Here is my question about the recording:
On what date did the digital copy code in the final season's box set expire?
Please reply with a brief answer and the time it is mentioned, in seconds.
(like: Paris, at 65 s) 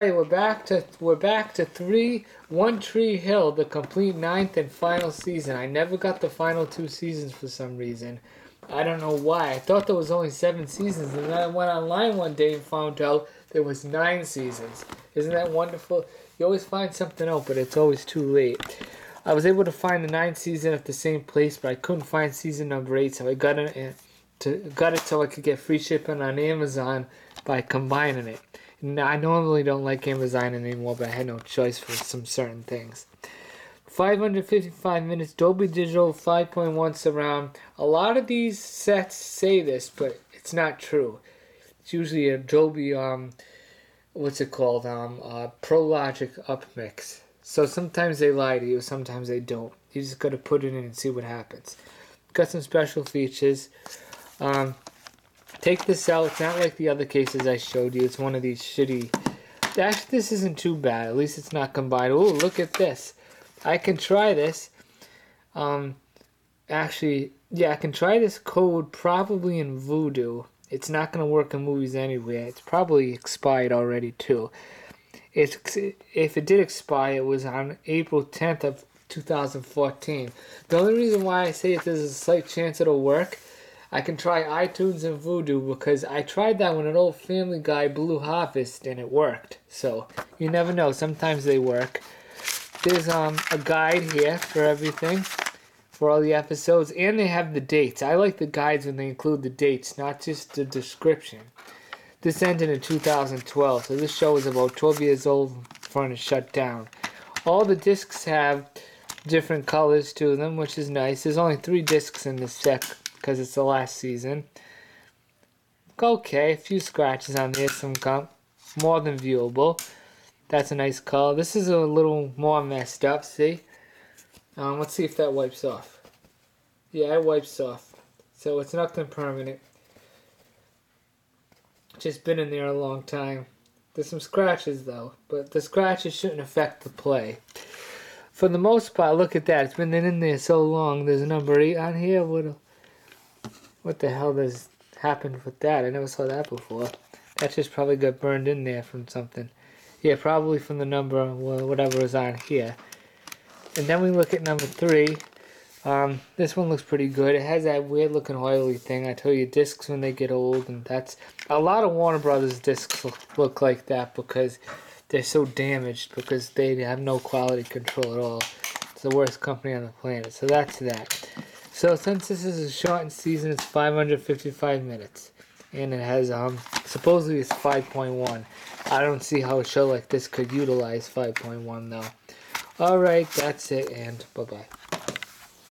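April 10, 2014, at 77 s.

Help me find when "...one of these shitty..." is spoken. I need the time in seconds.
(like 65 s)
58 s.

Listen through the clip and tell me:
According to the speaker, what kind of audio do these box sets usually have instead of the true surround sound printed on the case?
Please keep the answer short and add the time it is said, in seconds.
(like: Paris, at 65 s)
ProLogic upmix, at 45 s.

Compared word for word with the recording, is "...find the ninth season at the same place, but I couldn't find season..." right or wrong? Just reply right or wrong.
right.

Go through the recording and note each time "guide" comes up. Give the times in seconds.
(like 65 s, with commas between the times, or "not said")
93 s, 98 s.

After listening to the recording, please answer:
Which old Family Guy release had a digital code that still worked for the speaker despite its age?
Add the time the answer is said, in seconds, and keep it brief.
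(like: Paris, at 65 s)
Blue Harvest, at 87 s.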